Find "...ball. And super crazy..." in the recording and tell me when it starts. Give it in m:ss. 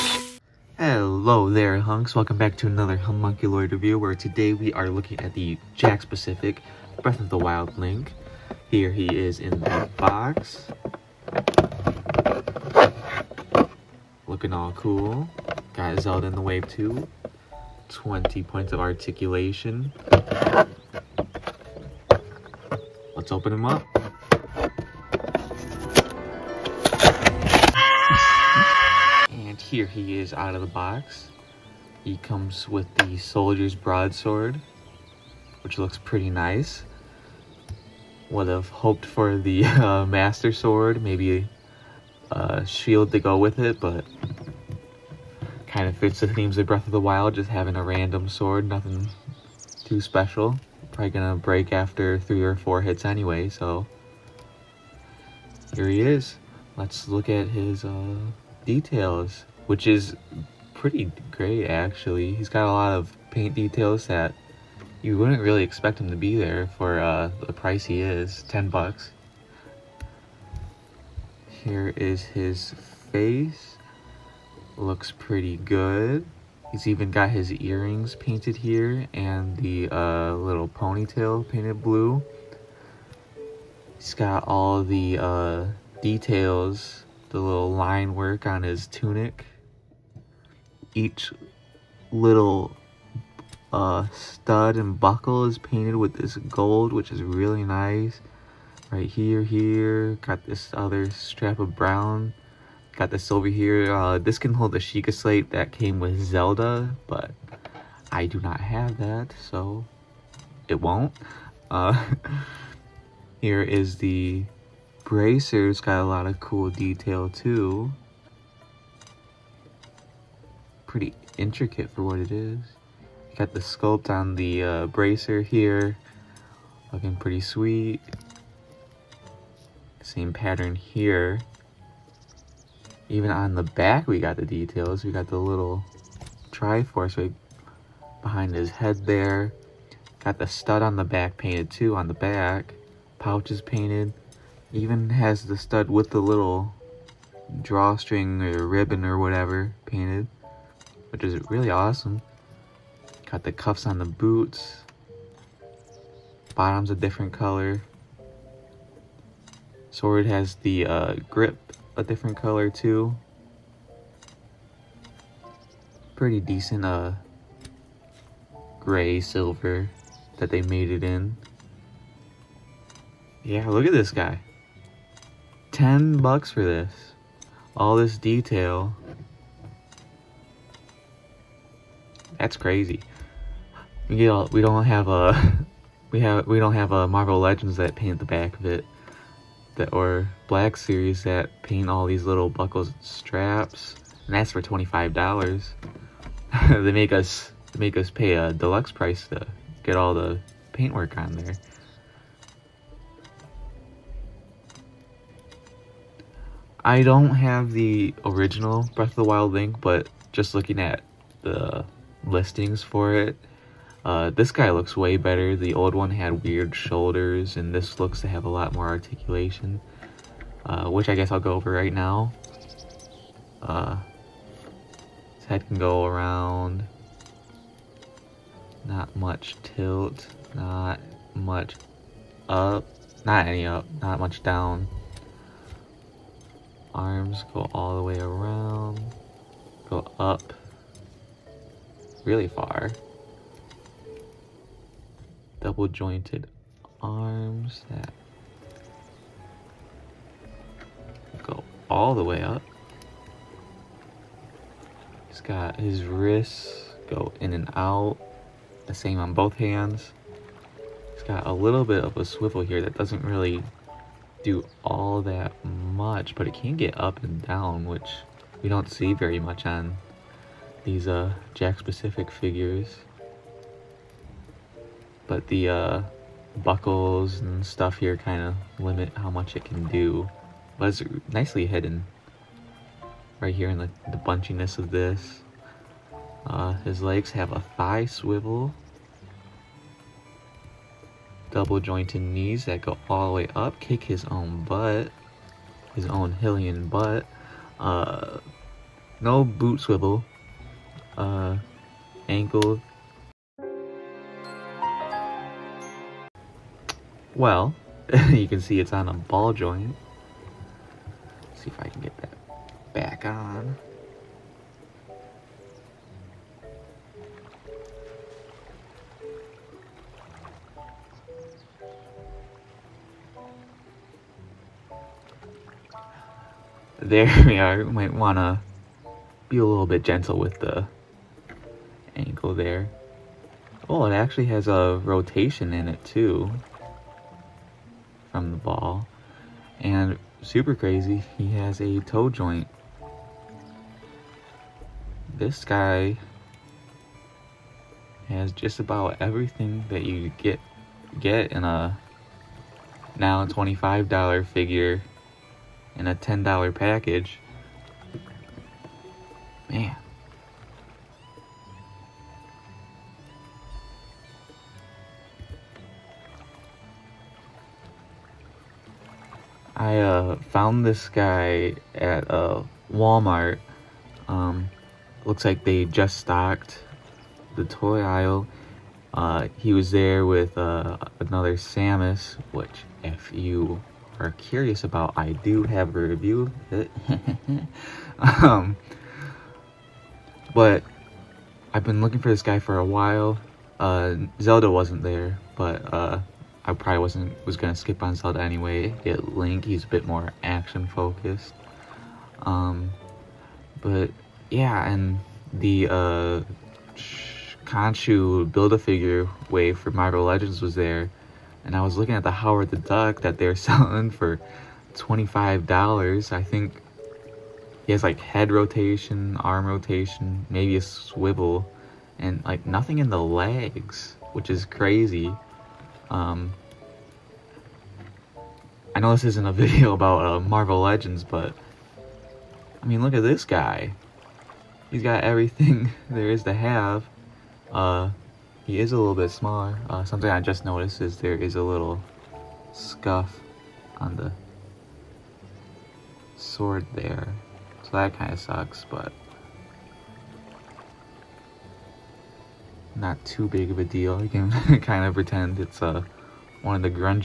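5:38.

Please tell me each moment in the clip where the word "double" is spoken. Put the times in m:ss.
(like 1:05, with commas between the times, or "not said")
4:05, 4:51.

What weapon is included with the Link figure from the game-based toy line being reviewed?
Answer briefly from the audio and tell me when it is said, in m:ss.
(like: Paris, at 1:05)
Soldier's broadsword, at 0:33.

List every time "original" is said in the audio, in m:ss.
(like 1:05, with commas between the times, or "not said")
3:28.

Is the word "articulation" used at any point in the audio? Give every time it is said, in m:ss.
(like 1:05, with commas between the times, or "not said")
0:18, 3:38.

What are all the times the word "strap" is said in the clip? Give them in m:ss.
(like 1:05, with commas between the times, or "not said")
1:41, 3:13.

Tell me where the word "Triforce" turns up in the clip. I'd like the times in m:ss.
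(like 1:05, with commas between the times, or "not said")
2:16.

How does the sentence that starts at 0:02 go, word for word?
Welcome back to another Homunculoid review, where today we are looking at the Jakks Pacific Breath of the Wild Link.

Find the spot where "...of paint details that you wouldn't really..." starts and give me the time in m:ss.
1:02.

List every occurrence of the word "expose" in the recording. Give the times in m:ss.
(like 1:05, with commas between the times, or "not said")
not said.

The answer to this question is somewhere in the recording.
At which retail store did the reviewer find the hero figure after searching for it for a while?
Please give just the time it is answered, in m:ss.
6:12.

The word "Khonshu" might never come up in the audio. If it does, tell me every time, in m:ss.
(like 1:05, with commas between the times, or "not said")
6:47.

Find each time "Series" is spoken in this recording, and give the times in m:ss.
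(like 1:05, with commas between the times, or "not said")
3:10.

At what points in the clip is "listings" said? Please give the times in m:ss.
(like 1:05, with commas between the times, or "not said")
3:32.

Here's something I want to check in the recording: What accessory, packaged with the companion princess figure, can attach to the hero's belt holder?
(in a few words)
Sheikah slate.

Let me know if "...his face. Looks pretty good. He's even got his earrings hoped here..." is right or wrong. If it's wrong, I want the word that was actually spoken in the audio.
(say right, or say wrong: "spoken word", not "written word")
wrong: "painted", not "hoped".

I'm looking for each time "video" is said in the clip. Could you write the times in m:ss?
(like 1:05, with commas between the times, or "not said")
7:09.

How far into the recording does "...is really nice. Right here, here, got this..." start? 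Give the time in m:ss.
1:37.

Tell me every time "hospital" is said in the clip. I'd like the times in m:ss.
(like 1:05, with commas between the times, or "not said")
not said.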